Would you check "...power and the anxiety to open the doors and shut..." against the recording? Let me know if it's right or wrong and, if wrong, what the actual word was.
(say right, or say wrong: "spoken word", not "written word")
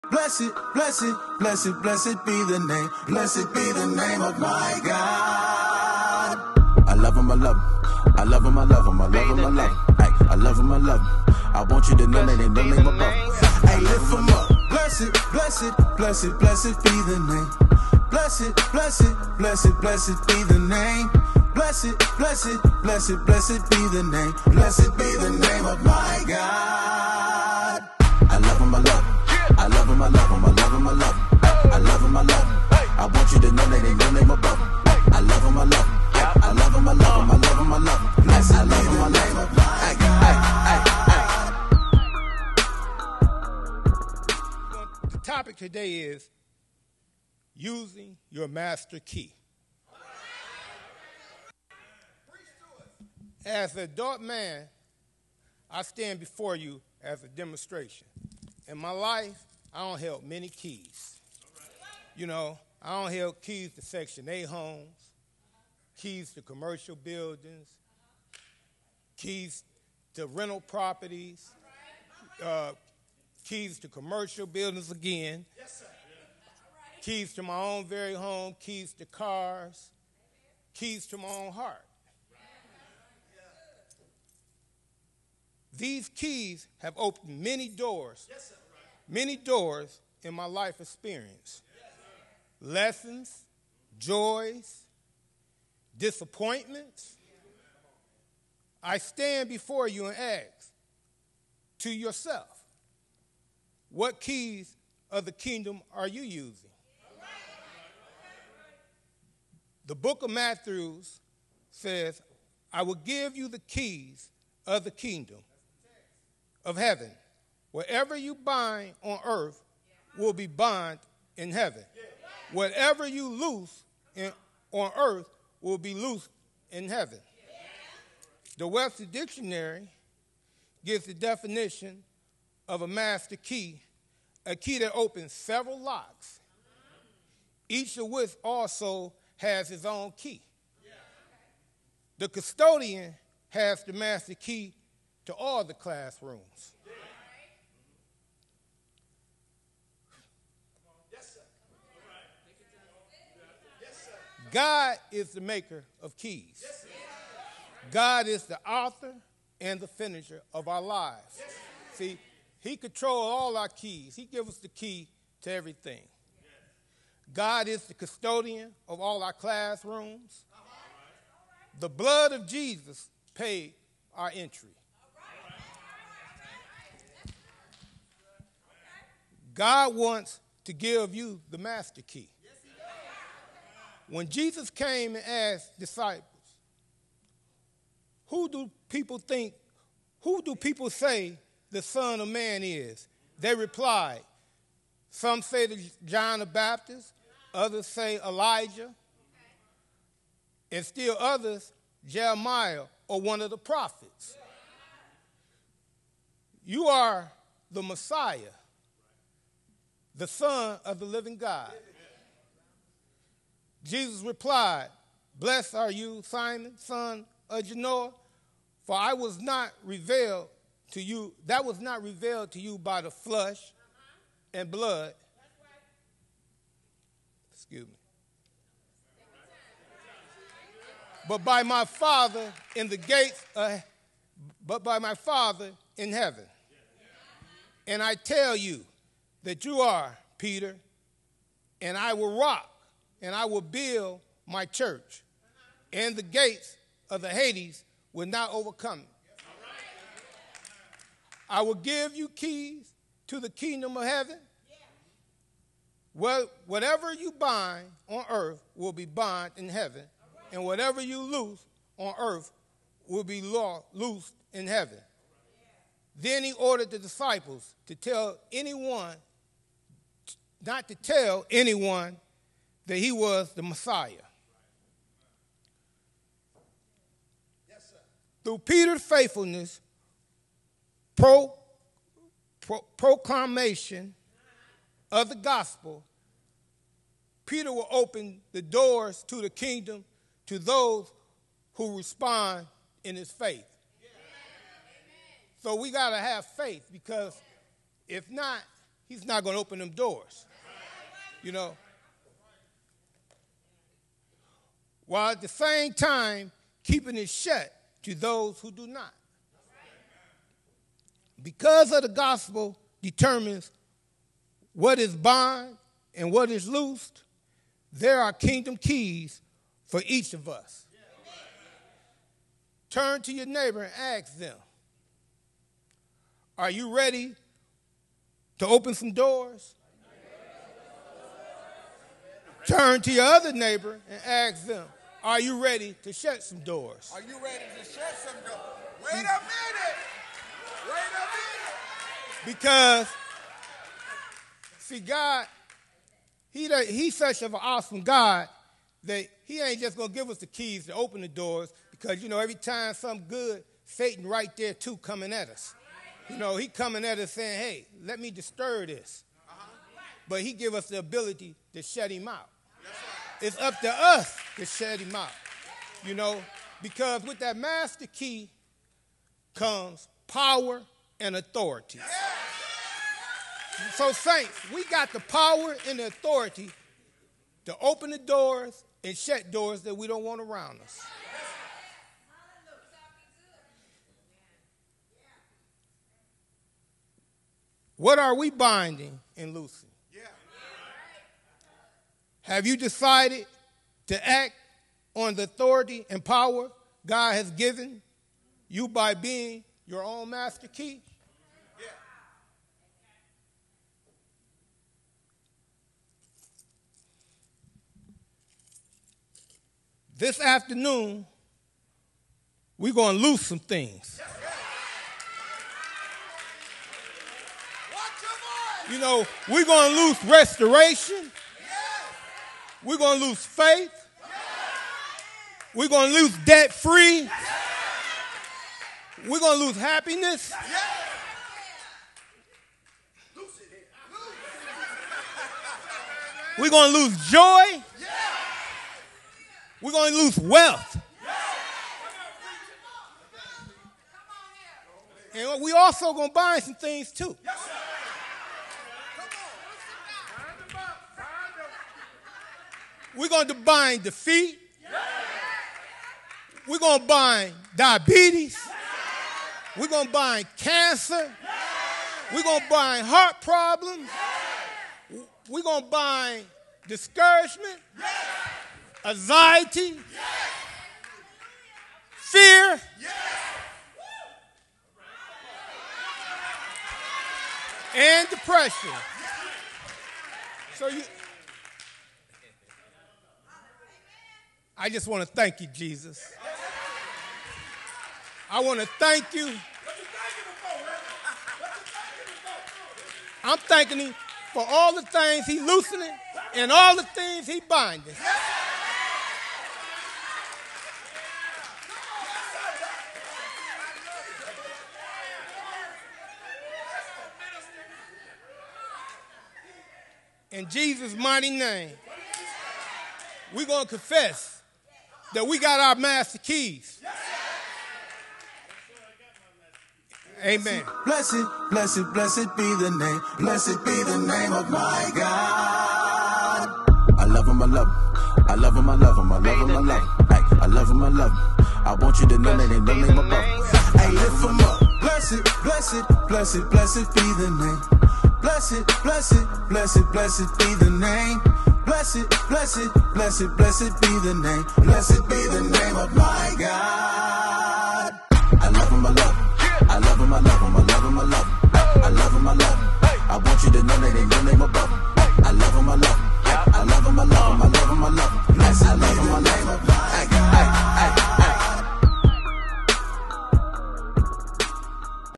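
wrong: "authority", not "anxiety".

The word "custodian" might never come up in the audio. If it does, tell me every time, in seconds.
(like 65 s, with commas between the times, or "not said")
142 s, 167 s.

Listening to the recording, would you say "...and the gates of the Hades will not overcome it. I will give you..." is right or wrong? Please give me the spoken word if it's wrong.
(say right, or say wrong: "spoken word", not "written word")
right.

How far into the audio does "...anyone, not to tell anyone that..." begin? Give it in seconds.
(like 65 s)
268 s.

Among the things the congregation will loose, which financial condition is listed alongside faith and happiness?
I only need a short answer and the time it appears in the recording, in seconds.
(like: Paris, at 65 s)
Debt free, at 426 s.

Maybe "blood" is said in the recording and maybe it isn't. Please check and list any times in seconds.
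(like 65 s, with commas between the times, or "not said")
171 s, 224 s.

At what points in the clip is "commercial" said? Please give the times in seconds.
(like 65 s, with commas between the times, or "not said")
66 s, 73 s.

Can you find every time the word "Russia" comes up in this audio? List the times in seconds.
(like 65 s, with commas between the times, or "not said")
not said.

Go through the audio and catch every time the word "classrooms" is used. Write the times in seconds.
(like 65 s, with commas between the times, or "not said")
145 s, 169 s.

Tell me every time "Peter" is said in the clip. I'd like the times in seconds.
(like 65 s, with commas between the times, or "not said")
240 s, 278 s, 287 s.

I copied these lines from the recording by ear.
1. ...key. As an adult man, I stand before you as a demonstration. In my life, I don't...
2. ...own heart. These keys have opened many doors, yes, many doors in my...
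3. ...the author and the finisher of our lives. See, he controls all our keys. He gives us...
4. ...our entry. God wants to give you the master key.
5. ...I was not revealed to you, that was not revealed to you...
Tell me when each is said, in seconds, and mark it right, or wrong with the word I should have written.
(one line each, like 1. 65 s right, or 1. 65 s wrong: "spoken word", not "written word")
1. 48 s right
2. 81 s right
3. 158 s right
4. 174 s right
5. 218 s right.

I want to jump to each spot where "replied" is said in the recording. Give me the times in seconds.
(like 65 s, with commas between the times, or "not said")
193 s, 214 s.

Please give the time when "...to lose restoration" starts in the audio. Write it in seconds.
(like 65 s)
419 s.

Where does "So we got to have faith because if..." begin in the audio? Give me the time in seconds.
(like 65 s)
295 s.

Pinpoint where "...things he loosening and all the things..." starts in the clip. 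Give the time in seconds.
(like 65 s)
495 s.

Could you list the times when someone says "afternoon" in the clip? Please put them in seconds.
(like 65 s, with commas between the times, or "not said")
410 s.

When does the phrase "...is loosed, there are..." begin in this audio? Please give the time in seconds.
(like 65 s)
316 s.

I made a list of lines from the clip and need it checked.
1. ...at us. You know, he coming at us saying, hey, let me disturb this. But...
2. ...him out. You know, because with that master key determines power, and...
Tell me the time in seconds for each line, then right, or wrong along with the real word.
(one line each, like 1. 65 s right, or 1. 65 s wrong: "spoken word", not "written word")
1. 355 s right
2. 365 s wrong: "comes", not "determines".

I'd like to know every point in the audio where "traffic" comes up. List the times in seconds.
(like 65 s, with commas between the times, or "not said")
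not said.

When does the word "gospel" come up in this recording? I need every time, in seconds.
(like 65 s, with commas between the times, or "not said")
285 s, 312 s.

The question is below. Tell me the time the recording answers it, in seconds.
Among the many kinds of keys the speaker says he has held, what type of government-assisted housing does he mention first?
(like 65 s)
63 s.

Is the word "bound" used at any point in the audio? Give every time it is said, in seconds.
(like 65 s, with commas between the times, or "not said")
120 s, 259 s, 315 s.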